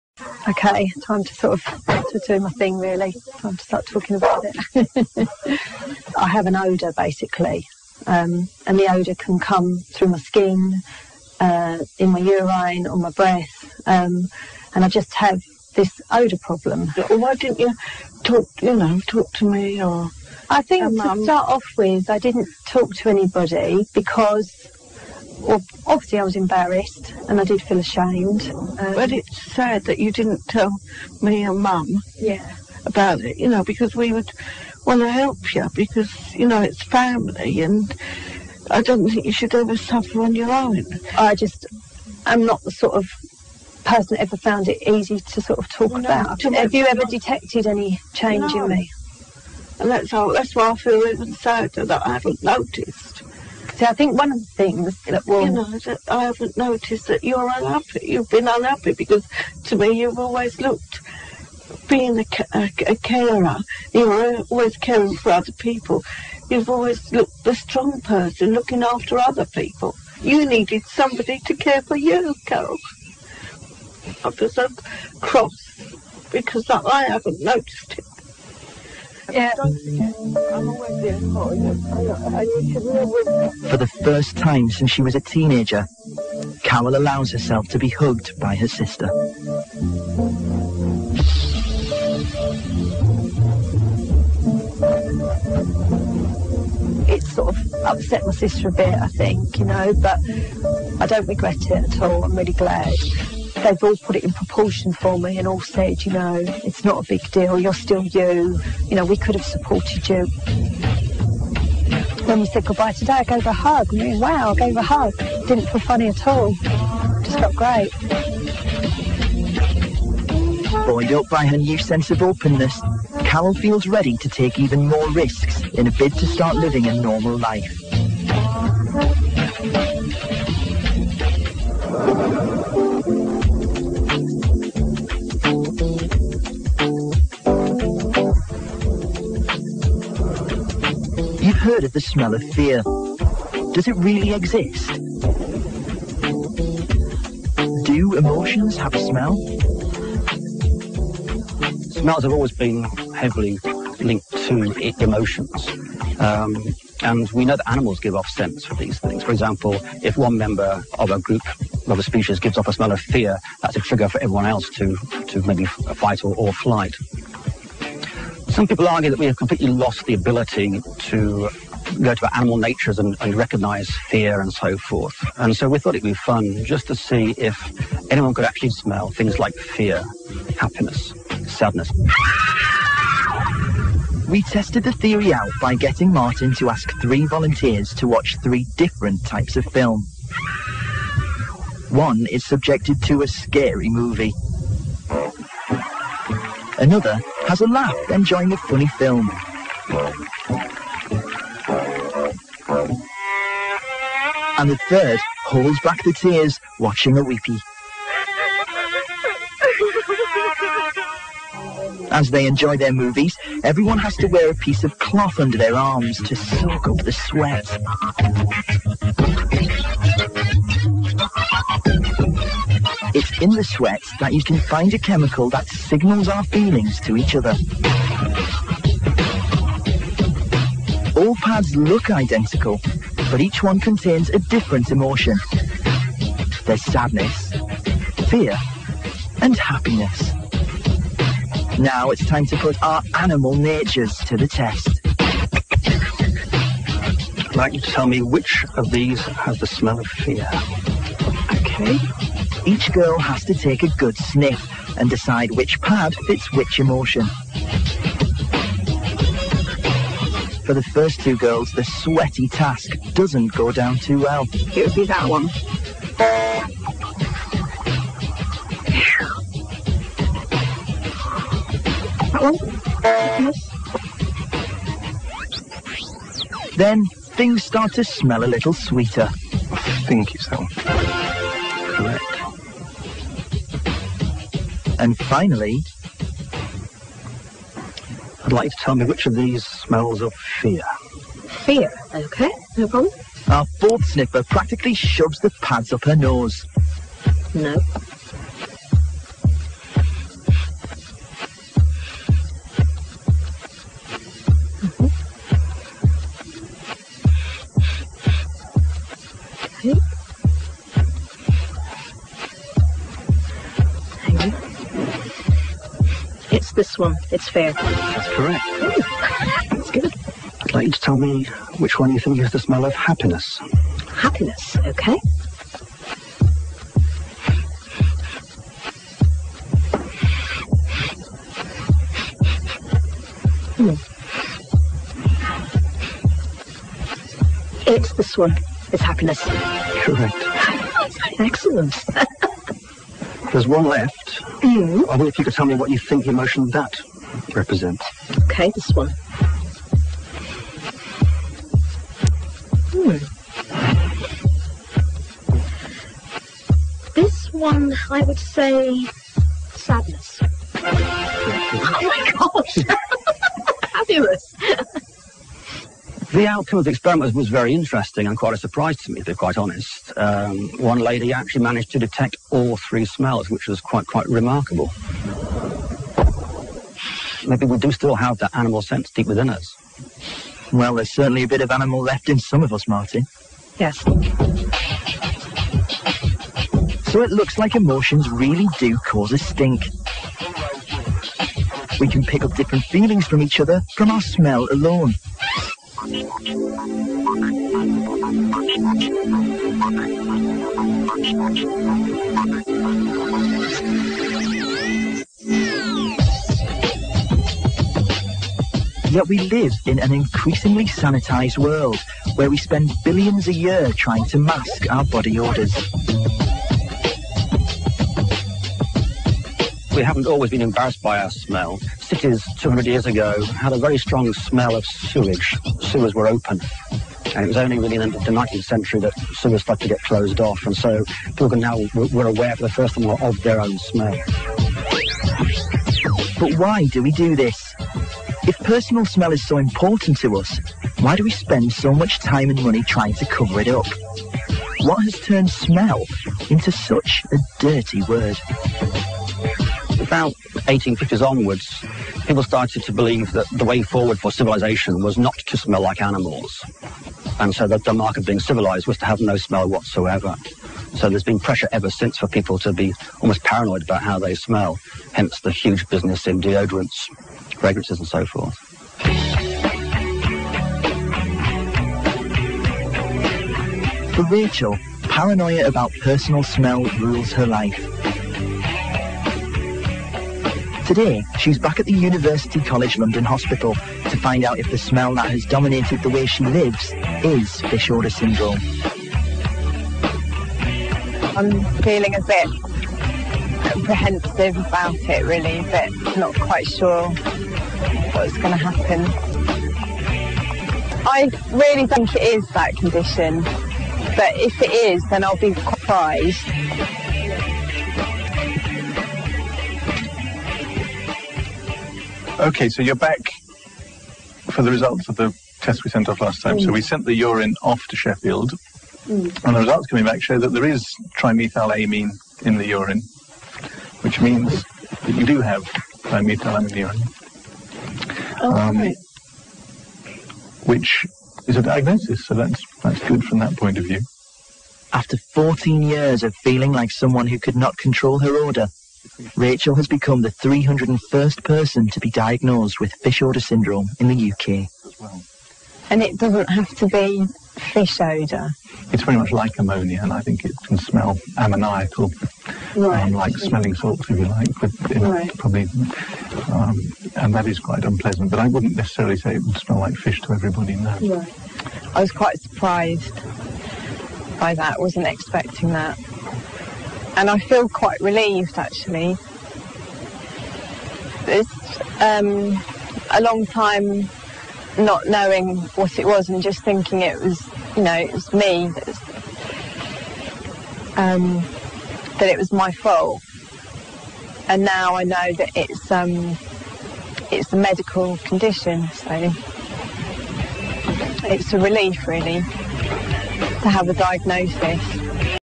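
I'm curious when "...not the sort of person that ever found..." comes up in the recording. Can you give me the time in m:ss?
0:42.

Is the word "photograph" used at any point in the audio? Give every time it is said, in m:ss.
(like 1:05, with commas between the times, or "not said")
not said.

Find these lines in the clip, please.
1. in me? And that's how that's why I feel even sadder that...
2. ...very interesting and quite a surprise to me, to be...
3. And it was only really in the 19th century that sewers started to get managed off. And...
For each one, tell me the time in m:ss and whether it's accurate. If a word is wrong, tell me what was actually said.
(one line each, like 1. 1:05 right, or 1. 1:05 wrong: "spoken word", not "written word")
1. 0:48 right
2. 6:07 right
3. 7:07 wrong: "closed", not "managed".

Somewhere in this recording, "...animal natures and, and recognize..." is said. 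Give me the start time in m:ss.
2:52.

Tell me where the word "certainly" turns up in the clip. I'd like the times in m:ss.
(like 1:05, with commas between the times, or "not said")
6:21.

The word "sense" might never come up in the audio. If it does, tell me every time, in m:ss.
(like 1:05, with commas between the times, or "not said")
2:01, 6:18.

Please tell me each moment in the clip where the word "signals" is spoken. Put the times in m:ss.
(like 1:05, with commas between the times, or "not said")
3:45.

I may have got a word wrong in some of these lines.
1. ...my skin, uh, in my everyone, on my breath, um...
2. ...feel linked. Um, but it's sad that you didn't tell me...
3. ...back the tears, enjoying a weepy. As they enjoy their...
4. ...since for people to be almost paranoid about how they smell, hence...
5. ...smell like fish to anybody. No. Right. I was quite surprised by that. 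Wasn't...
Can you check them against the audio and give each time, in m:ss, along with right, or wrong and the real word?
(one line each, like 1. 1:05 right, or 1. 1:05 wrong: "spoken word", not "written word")
1. 0:10 wrong: "urine", not "everyone"
2. 0:27 wrong: "ashamed", not "linked"
3. 3:25 wrong: "watching", not "enjoying"
4. 7:41 right
5. 9:19 wrong: "everybody", not "anybody".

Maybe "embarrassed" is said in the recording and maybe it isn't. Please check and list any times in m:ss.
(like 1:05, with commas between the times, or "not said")
0:26, 7:00.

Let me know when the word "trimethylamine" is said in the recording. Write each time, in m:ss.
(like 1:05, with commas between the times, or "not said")
8:41, 8:46.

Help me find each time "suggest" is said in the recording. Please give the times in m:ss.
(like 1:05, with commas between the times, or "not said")
not said.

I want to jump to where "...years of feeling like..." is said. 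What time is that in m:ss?
8:55.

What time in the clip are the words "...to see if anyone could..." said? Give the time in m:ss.
2:56.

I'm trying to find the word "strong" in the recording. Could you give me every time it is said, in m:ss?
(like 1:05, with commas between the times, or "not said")
1:07, 7:03.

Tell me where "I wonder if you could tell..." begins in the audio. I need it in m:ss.
5:45.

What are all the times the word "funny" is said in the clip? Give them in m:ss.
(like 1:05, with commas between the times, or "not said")
1:55, 3:18.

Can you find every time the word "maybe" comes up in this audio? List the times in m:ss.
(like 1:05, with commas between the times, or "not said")
2:45, 6:17.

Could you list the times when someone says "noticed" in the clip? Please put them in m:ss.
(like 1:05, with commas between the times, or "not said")
0:52, 0:56, 1:17.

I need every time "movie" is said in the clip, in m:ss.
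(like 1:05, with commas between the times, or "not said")
3:13, 3:32.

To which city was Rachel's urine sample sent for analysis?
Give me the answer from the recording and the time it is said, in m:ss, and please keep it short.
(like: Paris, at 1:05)
Sheffield, at 8:37.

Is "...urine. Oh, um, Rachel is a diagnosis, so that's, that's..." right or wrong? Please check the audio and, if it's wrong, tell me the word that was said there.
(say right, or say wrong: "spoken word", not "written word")
wrong: "Which", not "Rachel".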